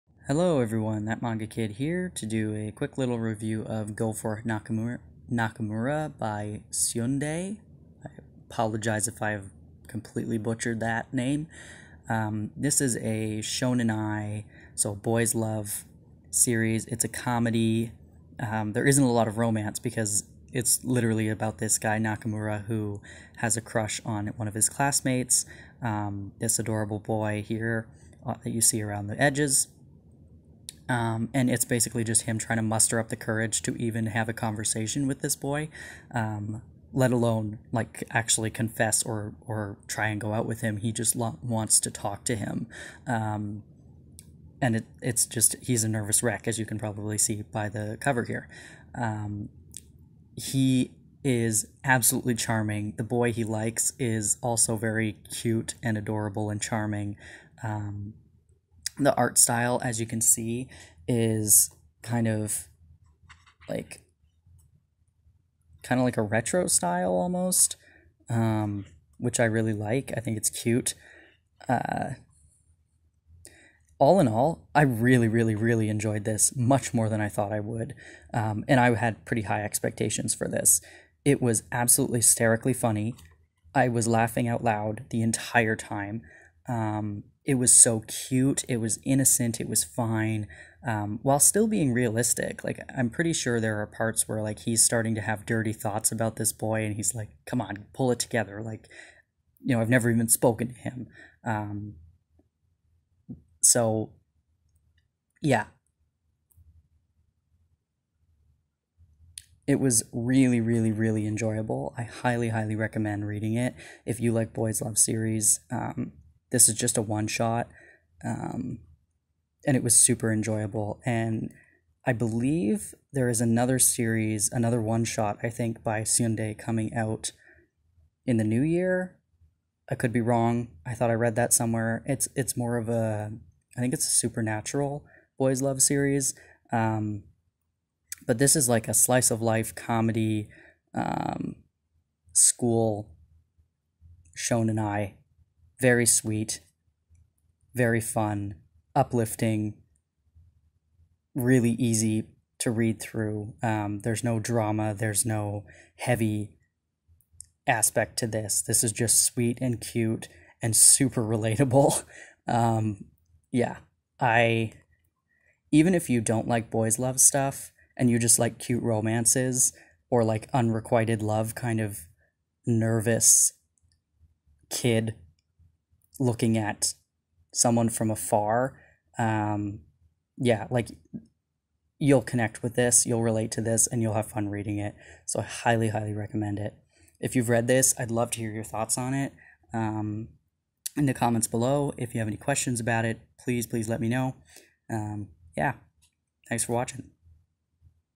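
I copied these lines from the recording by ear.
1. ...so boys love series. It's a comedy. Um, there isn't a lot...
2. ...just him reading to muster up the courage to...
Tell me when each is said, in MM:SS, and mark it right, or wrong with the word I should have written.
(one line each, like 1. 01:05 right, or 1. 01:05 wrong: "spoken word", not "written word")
1. 00:14 right
2. 00:32 wrong: "trying", not "reading".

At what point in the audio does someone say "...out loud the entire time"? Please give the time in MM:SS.
01:24.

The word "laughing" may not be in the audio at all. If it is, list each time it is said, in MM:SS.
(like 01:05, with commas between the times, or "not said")
01:24.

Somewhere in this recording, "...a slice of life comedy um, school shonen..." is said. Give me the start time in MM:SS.
02:18.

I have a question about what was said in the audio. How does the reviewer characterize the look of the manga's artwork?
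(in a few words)
Retro style.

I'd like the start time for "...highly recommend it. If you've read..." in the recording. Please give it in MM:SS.
03:05.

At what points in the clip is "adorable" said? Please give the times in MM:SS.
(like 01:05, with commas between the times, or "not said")
00:26, 00:55.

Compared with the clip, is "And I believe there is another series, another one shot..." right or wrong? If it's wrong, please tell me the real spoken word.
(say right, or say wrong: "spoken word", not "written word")
right.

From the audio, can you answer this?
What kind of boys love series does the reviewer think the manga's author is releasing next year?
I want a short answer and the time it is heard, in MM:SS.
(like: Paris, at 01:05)
Supernatural, at 02:14.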